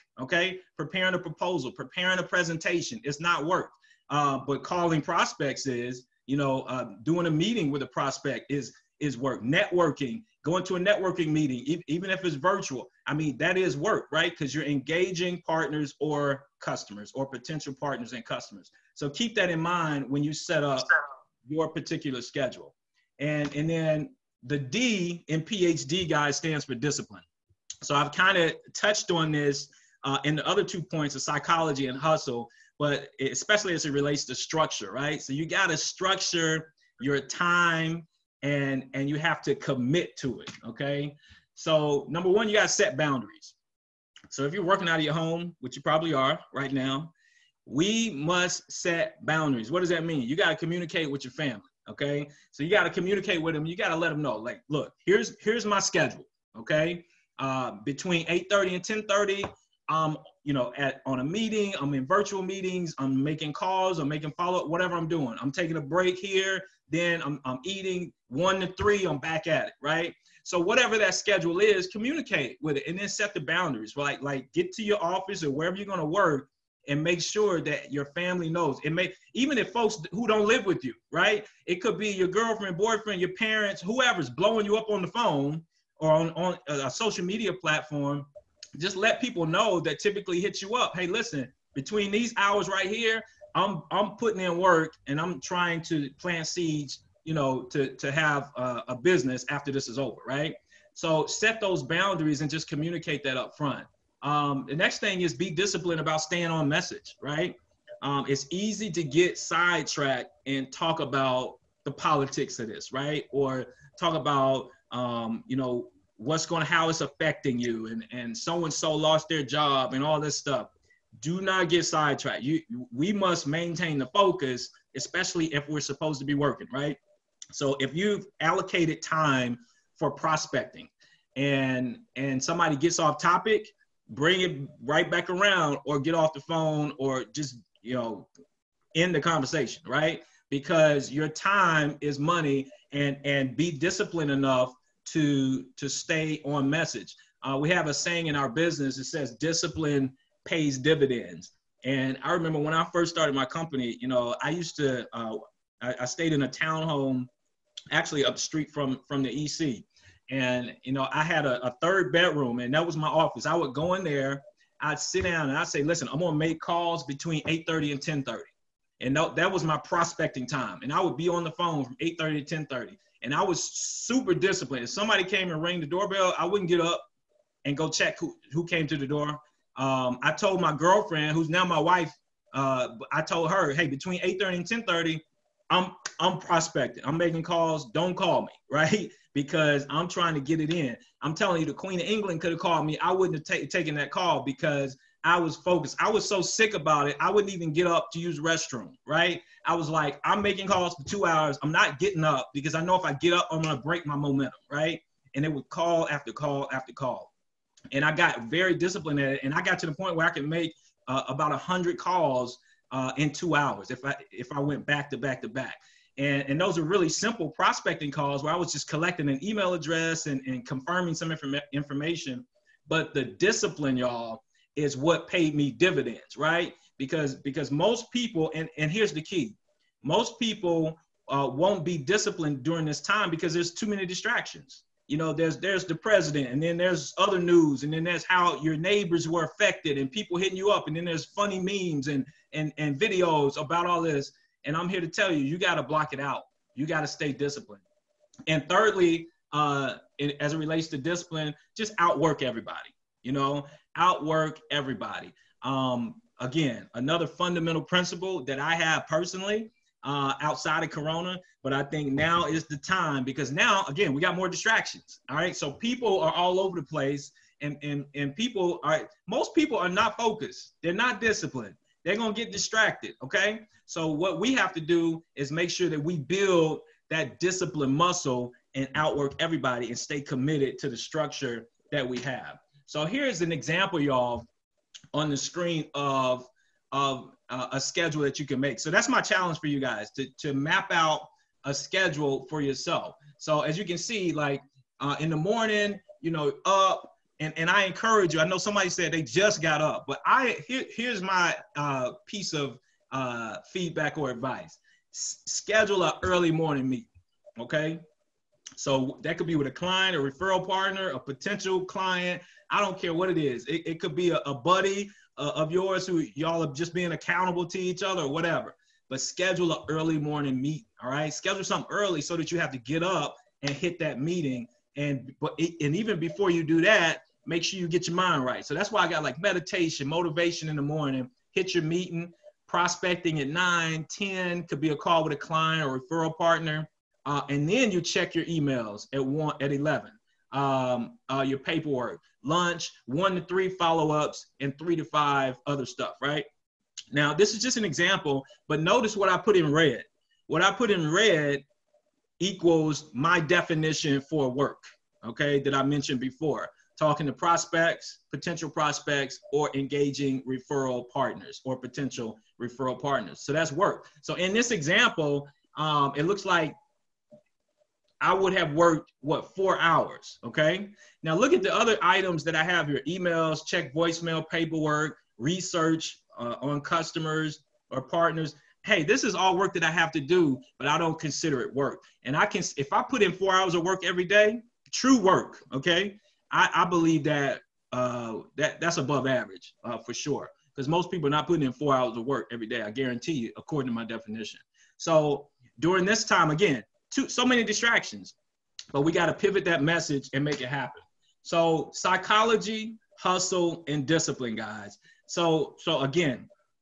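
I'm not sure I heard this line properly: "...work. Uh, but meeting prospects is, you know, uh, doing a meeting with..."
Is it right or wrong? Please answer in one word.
wrong.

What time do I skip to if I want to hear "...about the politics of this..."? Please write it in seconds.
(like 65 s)
110 s.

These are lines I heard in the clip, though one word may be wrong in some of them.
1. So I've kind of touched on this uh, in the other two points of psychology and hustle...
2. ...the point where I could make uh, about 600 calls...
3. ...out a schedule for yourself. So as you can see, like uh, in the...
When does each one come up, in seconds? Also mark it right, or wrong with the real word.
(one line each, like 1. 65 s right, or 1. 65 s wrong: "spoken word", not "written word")
1. 27 s right
2. 209 s wrong: "100", not "600"
3. 290 s right.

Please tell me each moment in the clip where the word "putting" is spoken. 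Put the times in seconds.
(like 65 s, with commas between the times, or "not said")
94 s, 391 s.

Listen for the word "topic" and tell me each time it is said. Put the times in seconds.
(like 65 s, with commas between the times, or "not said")
133 s.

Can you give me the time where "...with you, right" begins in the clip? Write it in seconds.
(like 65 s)
80 s.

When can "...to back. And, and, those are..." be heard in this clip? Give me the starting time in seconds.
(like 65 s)
215 s.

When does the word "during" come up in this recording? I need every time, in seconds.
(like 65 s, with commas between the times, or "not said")
232 s, 395 s.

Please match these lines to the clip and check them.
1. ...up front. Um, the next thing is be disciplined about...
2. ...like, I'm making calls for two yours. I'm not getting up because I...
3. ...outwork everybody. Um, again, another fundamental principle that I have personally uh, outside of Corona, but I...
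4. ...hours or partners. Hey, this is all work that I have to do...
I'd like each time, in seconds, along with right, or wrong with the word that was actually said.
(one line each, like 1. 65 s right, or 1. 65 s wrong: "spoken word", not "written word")
1. 103 s right
2. 199 s wrong: "hours", not "yours"
3. 253 s right
4. 376 s wrong: "customers", not "hours".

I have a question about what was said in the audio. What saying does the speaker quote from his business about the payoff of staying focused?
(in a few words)
Discipline pays dividends.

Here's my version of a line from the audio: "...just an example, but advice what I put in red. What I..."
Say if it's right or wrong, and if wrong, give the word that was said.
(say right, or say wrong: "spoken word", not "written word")
wrong: "notice", not "advice".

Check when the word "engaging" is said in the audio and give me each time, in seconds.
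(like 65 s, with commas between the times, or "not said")
14 s, 359 s.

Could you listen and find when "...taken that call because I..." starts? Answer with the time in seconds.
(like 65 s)
193 s.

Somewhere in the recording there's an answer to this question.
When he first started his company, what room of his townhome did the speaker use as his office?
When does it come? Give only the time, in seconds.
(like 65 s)
161 s.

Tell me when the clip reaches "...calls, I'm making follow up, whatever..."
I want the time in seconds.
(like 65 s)
63 s.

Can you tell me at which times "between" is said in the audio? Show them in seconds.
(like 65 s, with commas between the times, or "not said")
57 s, 91 s, 167 s, 183 s.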